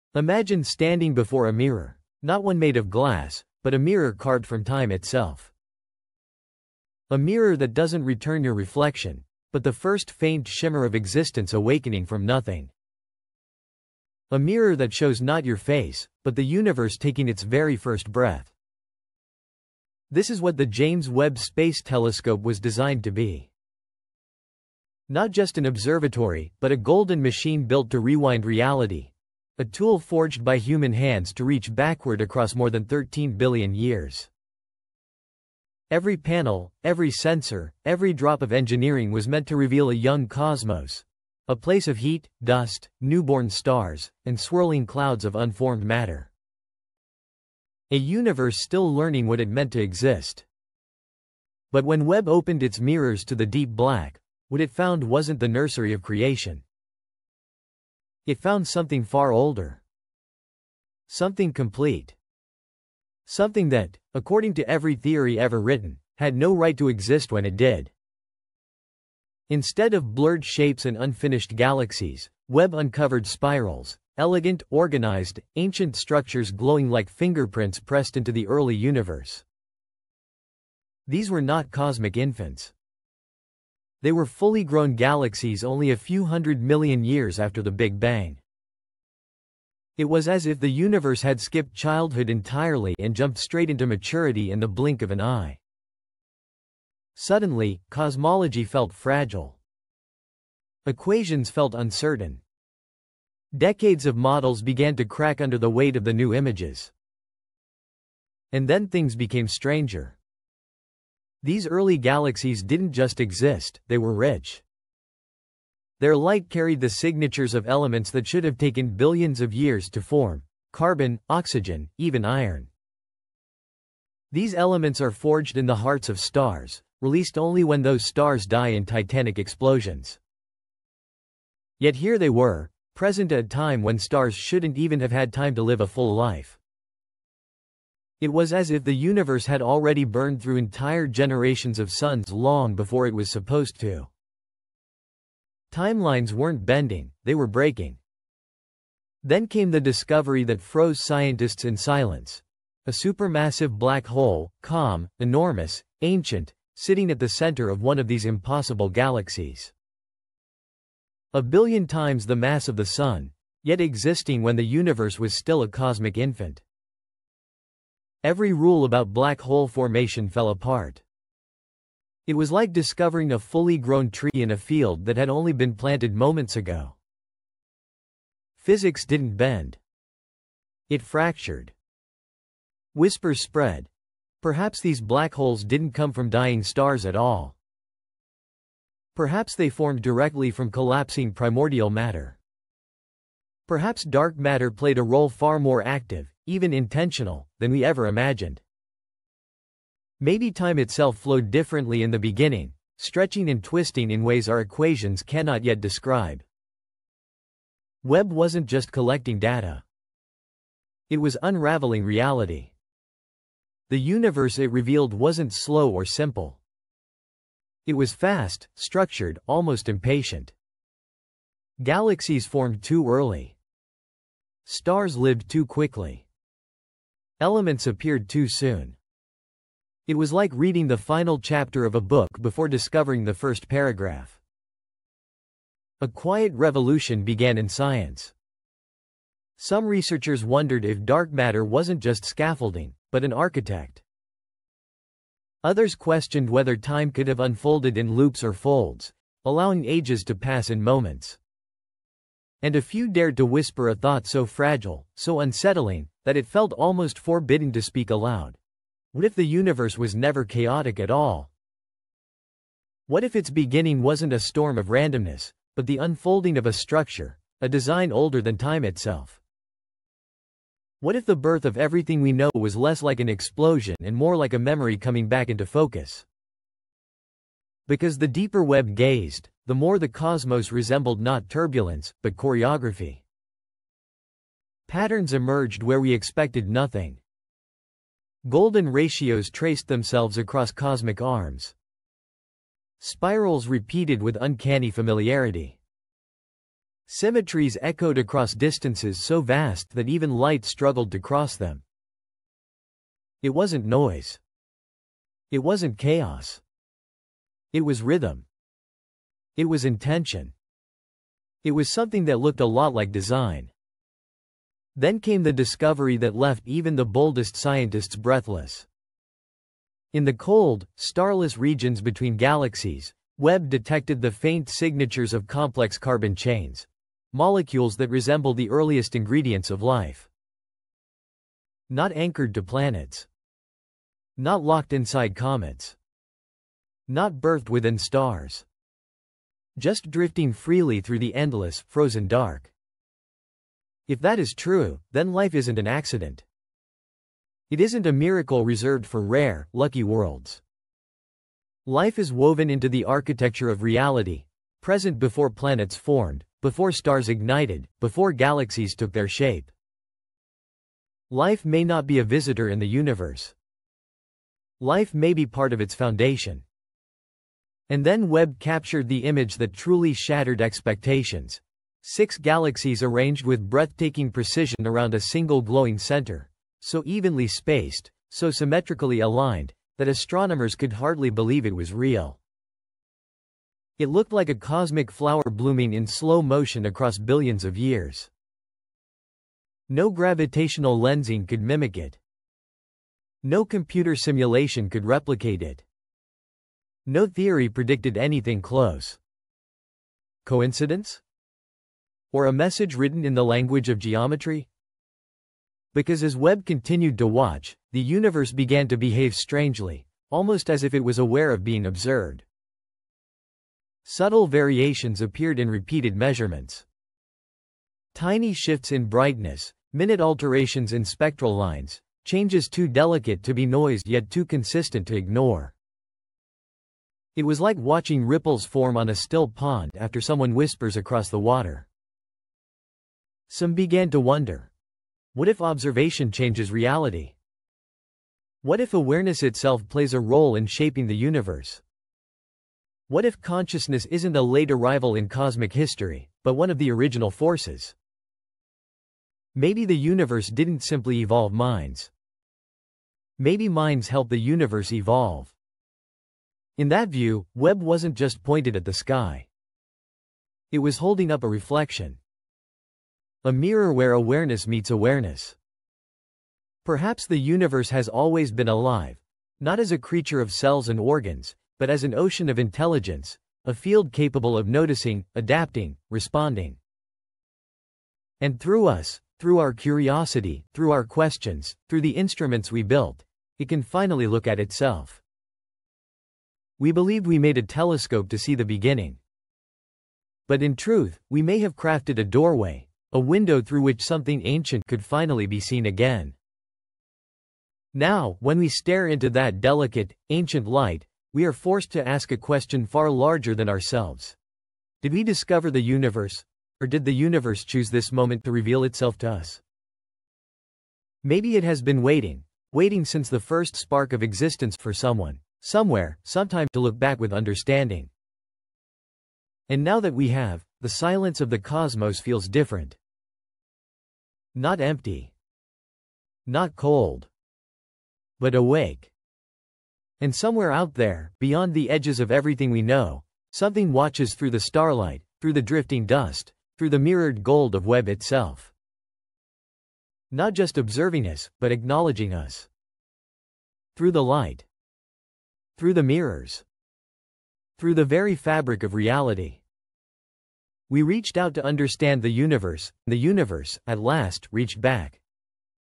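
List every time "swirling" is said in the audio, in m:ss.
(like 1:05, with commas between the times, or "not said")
0:44.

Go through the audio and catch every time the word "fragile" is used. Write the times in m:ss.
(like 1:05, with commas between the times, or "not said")
1:38, 4:14.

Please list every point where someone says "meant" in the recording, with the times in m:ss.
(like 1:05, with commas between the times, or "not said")
0:39, 0:49.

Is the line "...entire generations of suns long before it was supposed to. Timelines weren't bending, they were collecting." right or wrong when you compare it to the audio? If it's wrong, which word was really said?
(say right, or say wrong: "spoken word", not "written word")
wrong: "breaking", not "collecting".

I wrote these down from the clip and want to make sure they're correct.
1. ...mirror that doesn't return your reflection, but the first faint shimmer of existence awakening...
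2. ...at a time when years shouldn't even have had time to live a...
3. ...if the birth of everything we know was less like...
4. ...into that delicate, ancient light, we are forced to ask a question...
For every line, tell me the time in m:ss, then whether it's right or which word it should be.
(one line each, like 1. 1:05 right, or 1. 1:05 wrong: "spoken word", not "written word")
1. 0:07 right
2. 2:13 wrong: "stars", not "years"
3. 4:31 right
4. 8:19 right.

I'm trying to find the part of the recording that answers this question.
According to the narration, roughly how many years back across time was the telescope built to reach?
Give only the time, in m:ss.
0:32.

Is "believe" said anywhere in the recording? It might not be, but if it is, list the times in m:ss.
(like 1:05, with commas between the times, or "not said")
6:21, 8:06.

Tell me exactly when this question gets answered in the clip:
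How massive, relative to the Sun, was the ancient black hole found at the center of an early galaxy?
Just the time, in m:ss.
2:41.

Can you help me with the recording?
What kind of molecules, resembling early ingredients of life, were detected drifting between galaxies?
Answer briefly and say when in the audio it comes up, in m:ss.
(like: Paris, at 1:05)
complex carbon chains, at 5:25.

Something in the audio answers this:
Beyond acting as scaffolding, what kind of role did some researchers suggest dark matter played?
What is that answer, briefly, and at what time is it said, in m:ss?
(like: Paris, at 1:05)
an architect, at 4:03.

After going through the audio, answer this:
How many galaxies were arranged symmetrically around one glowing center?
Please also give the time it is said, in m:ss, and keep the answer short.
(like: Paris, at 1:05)
6, at 6:12.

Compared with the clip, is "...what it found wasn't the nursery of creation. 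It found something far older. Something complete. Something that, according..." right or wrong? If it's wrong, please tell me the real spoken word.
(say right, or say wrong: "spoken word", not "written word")
right.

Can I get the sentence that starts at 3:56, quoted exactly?
A quiet revolution began in science.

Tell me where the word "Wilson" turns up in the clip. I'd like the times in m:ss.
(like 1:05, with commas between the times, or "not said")
not said.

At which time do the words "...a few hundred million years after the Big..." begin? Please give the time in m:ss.
1:25.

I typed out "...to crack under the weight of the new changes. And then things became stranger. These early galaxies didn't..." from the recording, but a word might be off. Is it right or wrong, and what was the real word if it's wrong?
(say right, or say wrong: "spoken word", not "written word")
wrong: "images", not "changes".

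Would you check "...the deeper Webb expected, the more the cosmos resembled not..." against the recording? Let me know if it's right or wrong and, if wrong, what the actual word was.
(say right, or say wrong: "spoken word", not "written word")
wrong: "gazed", not "expected".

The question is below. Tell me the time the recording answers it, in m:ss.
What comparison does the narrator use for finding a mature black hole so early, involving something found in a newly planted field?
2:53.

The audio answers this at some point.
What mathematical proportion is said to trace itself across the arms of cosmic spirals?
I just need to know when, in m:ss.
4:48.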